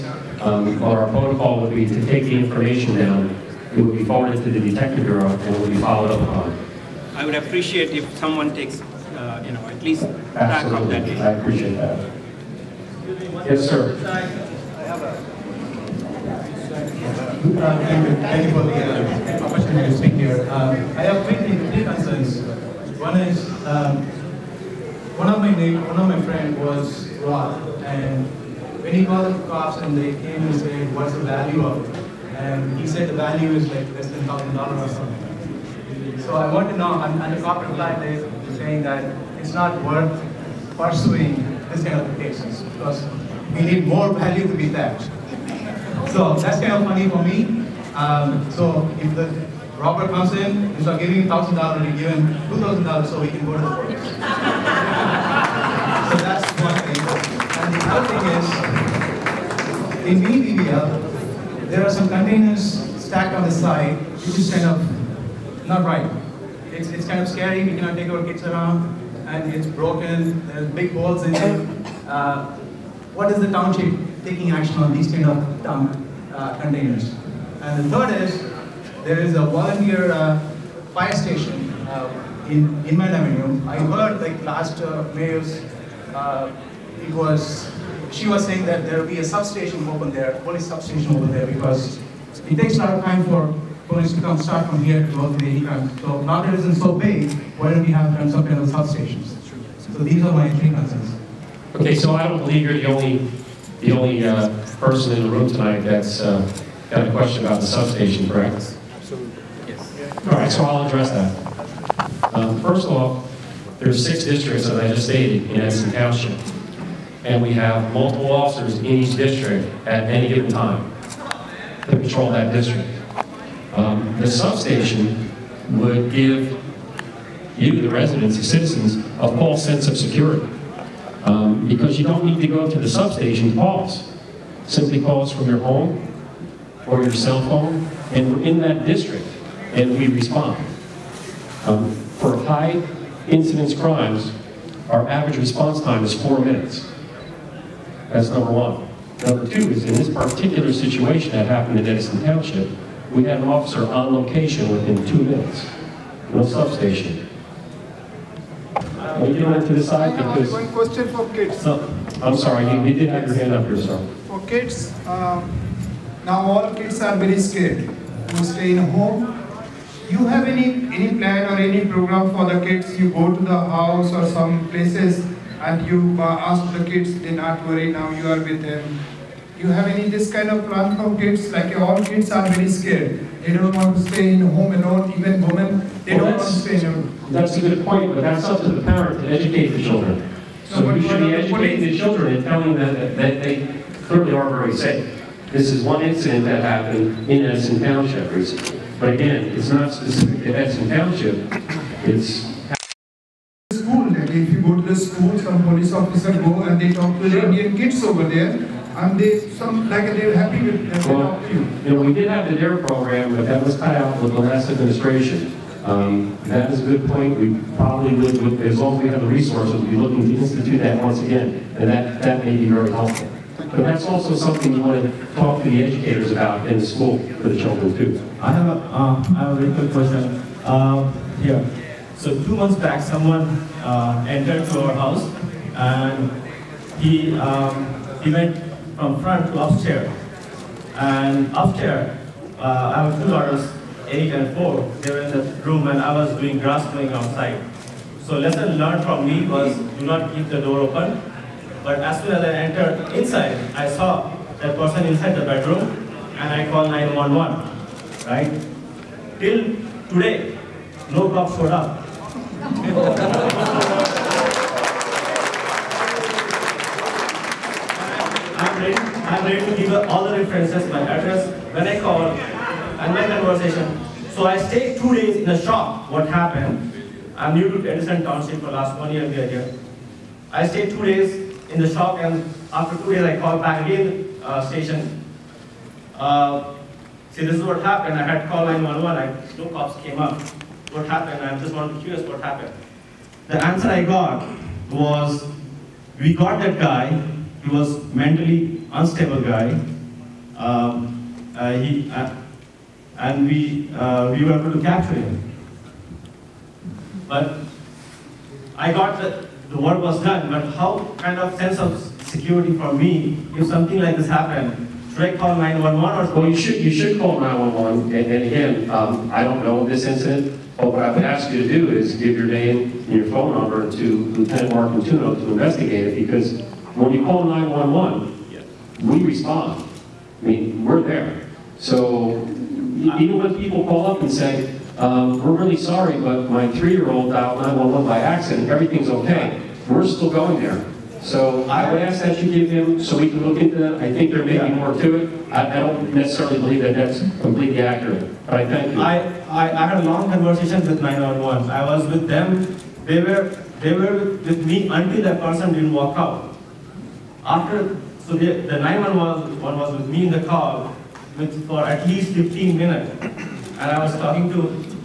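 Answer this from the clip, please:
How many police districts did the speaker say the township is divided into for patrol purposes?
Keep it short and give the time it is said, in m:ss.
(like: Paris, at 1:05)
6, at 1:53.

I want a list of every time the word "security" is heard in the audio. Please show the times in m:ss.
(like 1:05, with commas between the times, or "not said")
2:09, 5:12.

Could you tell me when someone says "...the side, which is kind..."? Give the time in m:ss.
1:03.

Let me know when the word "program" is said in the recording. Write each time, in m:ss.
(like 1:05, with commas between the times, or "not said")
2:51, 3:32.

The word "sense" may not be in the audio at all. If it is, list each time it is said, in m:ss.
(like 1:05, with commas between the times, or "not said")
2:09, 5:11.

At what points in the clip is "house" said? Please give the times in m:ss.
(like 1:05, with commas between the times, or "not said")
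2:53, 3:54.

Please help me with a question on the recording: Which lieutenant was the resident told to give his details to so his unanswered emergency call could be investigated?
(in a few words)
Mark Antuno.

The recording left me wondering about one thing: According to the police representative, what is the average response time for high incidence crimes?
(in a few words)
4 minutes.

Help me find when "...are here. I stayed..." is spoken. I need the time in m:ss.
4:39.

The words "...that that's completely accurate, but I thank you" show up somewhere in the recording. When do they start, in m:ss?
5:46.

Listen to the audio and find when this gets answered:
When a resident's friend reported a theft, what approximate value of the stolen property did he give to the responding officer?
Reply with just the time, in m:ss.
0:33.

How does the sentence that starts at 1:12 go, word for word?
Uh, what is the township taking action on these kind of dumb uh, containers?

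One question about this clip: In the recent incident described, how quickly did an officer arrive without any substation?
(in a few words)
2 minutes.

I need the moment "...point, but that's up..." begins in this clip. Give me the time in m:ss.
3:07.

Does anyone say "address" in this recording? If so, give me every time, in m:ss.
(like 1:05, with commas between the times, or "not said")
1:50, 4:31.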